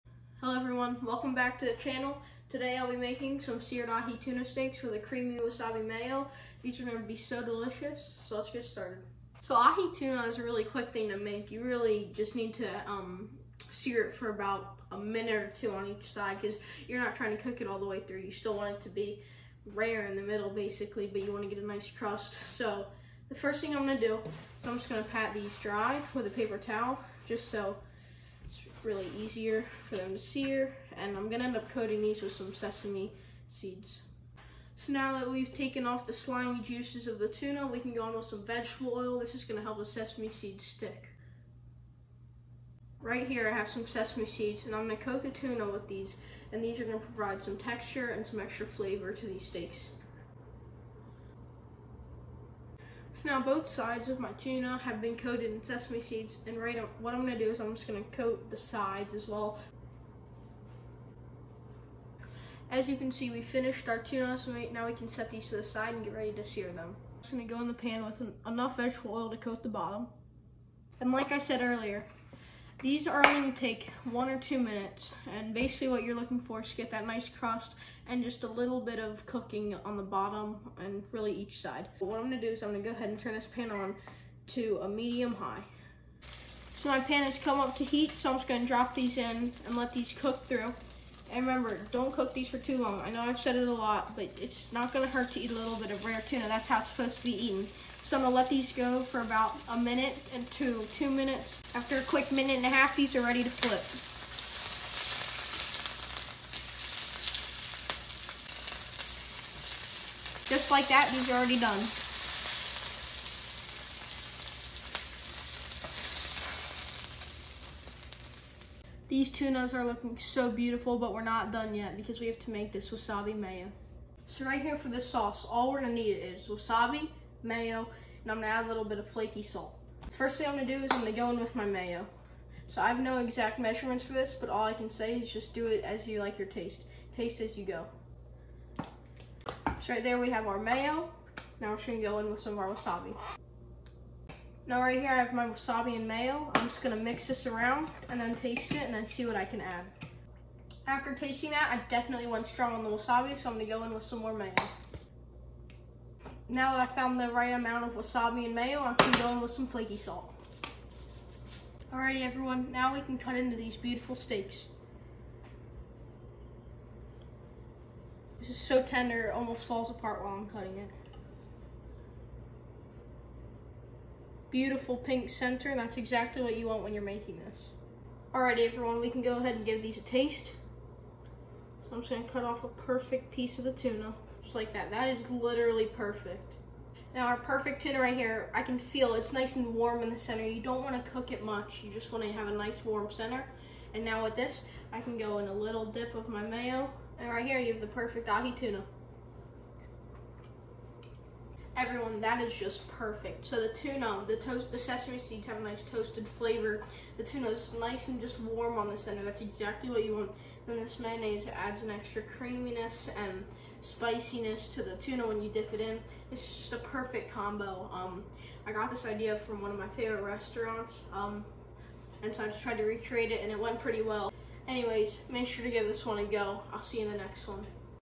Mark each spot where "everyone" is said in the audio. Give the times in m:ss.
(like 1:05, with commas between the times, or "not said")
0:00, 2:42, 2:58, 3:21.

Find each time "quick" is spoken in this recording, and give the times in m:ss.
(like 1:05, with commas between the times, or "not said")
0:10, 1:42.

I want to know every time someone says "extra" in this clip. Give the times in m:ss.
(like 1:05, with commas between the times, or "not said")
0:48, 3:31.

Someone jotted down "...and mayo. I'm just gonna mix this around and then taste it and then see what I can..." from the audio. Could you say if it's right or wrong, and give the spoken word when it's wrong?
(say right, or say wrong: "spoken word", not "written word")
right.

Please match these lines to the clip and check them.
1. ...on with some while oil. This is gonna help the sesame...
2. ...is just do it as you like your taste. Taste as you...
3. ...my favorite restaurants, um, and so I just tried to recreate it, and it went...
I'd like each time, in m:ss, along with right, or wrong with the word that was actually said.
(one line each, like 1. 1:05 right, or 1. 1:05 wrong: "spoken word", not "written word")
1. 0:38 wrong: "vegetable", not "while"
2. 2:15 right
3. 3:39 right.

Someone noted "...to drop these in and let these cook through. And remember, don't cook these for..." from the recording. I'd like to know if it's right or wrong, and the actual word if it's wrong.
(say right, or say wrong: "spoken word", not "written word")
right.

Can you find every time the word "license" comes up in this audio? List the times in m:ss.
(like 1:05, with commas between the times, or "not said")
not said.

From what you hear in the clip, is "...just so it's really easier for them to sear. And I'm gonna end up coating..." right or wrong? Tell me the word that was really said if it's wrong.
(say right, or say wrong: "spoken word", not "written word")
right.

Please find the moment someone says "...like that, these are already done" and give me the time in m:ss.
1:50.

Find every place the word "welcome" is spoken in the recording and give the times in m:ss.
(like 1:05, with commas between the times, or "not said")
0:01.